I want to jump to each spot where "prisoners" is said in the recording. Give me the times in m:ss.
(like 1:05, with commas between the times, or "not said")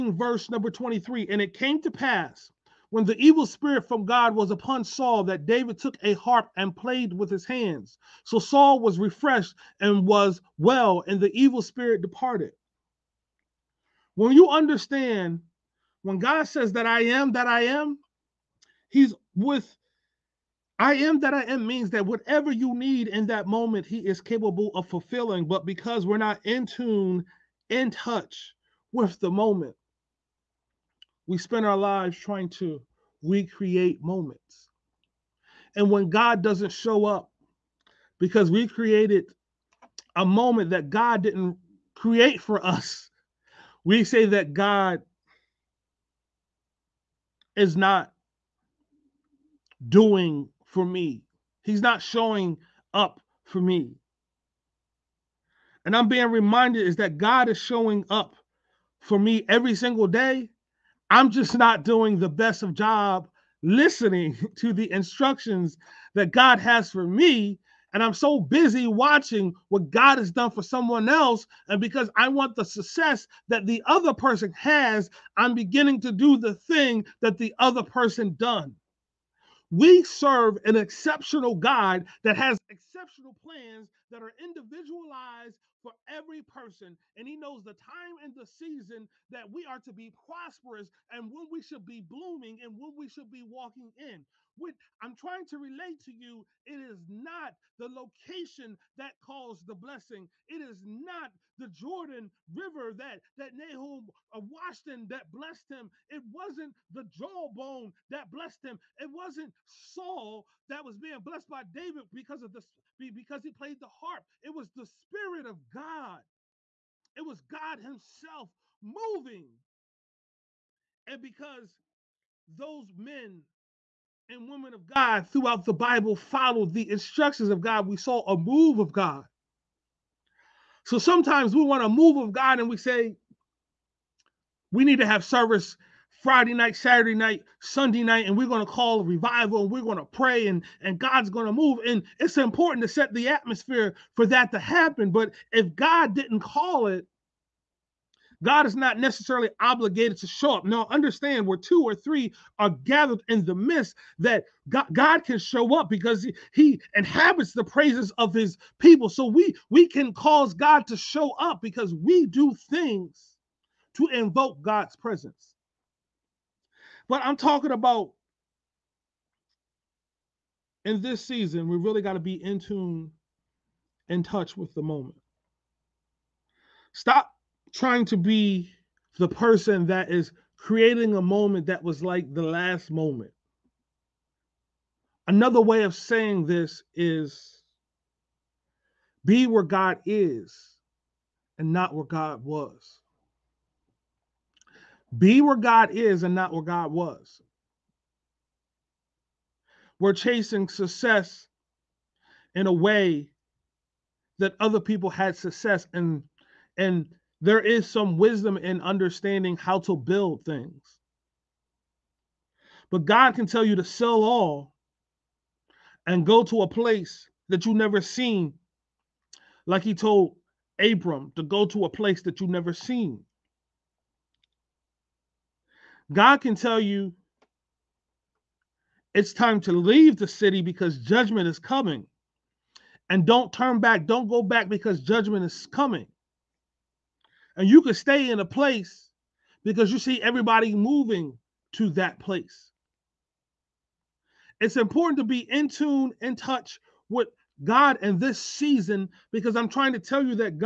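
not said.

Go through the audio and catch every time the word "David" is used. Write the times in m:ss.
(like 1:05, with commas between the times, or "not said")
0:05, 1:51.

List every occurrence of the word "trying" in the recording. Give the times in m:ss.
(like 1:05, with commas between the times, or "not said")
0:32, 1:35, 2:57, 4:09.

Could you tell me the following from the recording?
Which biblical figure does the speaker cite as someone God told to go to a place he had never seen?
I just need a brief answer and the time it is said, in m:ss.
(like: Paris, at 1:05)
Abram, at 3:40.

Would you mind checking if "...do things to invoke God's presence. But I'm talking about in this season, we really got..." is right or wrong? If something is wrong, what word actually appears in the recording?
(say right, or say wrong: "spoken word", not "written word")
right.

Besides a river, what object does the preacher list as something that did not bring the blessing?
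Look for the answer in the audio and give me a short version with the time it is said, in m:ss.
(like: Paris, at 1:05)
The jawbone, at 1:47.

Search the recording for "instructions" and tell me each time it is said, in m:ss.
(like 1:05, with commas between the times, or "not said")
1:04, 2:06.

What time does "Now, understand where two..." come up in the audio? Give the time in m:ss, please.
2:30.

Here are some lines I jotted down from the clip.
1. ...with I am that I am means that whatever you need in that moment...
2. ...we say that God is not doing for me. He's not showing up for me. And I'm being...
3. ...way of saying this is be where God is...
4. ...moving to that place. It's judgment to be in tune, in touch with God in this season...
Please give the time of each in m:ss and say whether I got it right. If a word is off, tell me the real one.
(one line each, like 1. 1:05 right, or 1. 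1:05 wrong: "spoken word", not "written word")
1. 0:19 right
2. 0:43 right
3. 3:05 right
4. 4:00 wrong: "important", not "judgment".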